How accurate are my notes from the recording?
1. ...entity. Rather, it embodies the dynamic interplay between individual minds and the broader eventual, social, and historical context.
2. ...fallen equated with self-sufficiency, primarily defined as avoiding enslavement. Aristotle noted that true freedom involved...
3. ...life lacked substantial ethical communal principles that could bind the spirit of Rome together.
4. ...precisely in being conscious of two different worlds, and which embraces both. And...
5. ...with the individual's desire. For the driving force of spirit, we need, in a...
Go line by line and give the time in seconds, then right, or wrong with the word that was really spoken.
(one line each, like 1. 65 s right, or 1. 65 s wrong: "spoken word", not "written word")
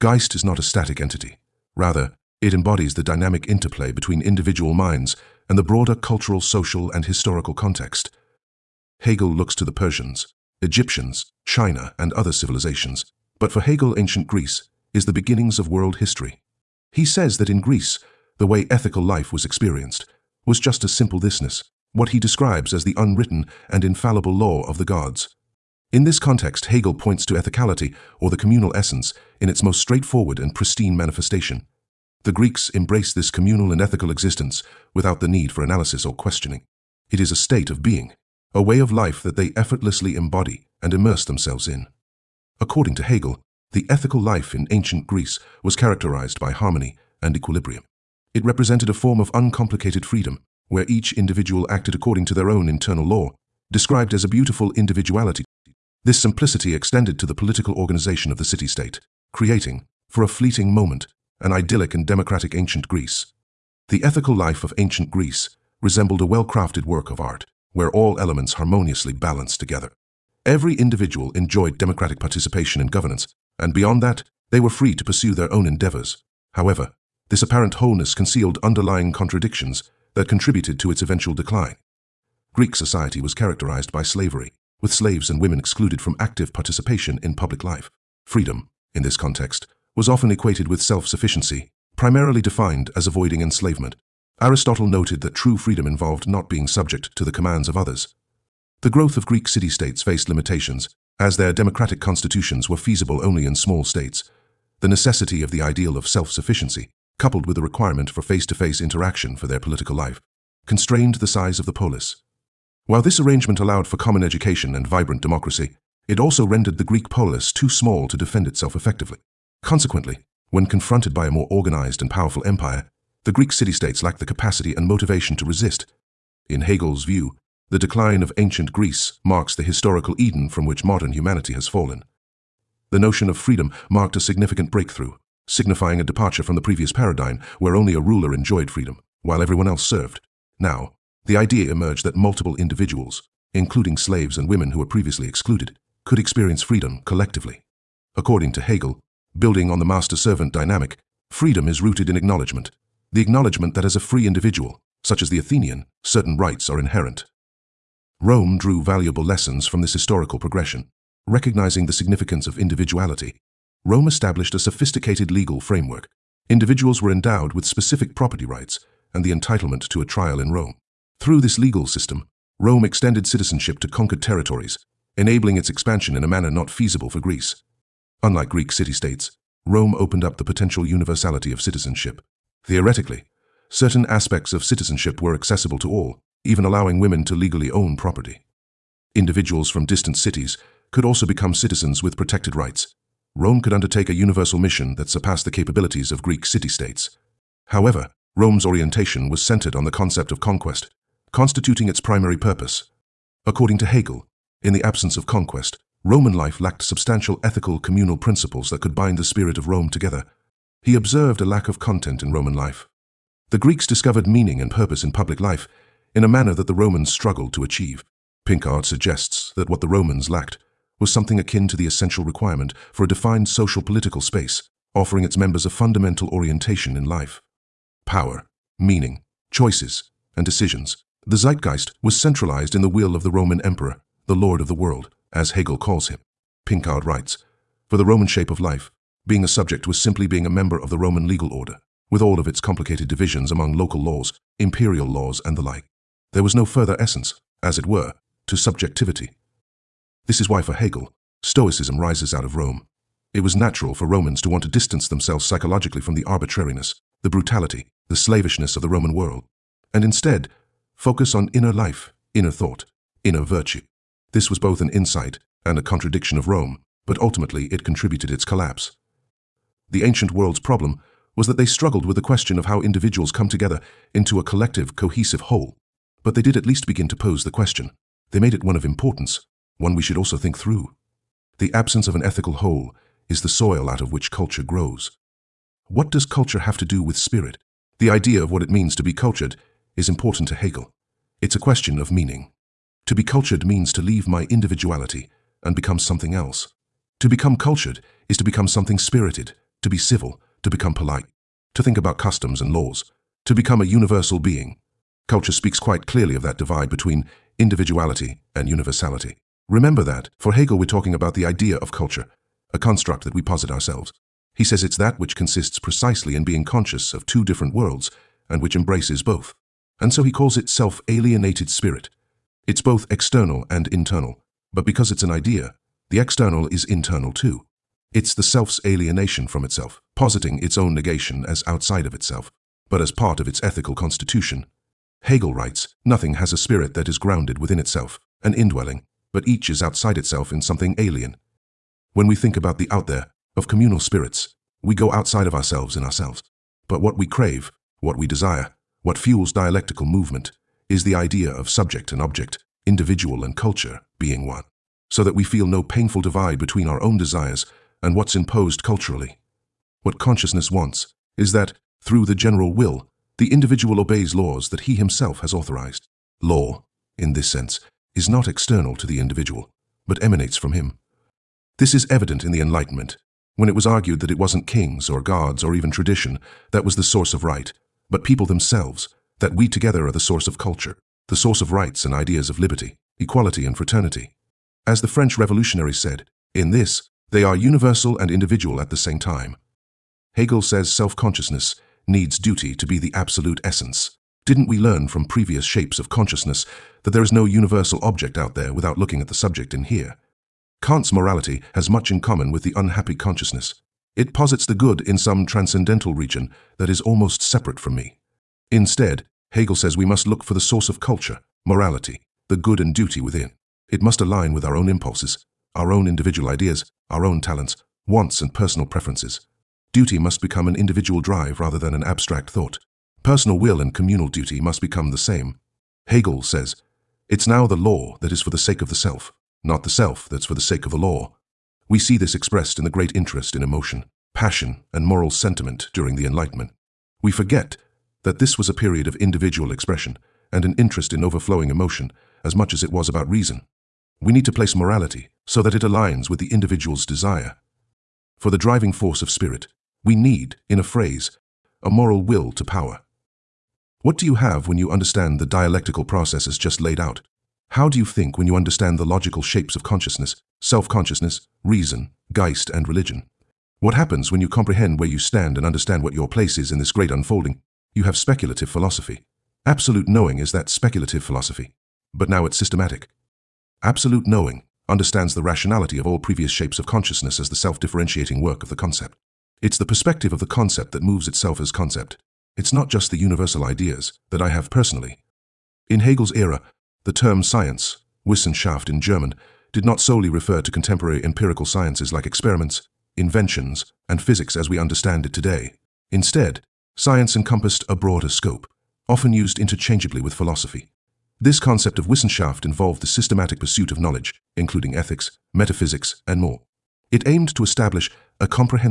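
1. 0 s wrong: "cultural", not "eventual"
2. 90 s wrong: "often", not "fallen"
3. 206 s right
4. 315 s right
5. 446 s right.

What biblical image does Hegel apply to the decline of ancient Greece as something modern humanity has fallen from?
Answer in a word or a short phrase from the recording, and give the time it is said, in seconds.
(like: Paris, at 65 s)
historical Eden, at 129 s.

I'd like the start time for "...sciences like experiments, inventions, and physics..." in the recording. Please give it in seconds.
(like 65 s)
491 s.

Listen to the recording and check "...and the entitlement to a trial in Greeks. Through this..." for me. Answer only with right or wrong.
wrong.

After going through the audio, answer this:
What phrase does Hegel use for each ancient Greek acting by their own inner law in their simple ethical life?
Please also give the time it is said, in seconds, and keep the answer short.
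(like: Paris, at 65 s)
beautiful individuality, at 54 s.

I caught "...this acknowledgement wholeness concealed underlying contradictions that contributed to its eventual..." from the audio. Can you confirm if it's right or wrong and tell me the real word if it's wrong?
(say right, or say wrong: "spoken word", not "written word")
wrong: "apparent", not "acknowledgement".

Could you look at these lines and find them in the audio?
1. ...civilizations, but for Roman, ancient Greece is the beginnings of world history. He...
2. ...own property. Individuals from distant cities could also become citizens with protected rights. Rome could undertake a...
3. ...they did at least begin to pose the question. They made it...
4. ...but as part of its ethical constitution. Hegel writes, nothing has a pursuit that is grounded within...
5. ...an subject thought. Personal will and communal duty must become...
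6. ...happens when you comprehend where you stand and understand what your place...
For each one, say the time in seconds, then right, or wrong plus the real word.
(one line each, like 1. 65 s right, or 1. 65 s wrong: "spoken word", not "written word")
1. 12 s wrong: "Hegel", not "Roman"
2. 187 s right
3. 276 s right
4. 332 s wrong: "spirit", not "pursuit"
5. 421 s wrong: "abstract", not "subject"
6. 463 s right.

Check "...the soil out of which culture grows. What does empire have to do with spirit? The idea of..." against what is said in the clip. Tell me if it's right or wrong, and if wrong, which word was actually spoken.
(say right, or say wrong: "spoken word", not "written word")
wrong: "culture", not "empire".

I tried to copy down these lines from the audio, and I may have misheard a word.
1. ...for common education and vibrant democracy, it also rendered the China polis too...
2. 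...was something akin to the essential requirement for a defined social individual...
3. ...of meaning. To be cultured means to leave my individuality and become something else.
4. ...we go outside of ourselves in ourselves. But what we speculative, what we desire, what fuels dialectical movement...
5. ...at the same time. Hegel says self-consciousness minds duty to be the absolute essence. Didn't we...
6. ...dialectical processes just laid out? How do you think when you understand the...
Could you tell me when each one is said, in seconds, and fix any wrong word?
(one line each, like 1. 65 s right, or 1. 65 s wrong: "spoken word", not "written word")
1. 113 s wrong: "Greek", not "China"
2. 221 s wrong: "political", not "individual"
3. 291 s right
4. 344 s wrong: "crave", not "speculative"
5. 388 s wrong: "needs", not "minds"
6. 455 s right.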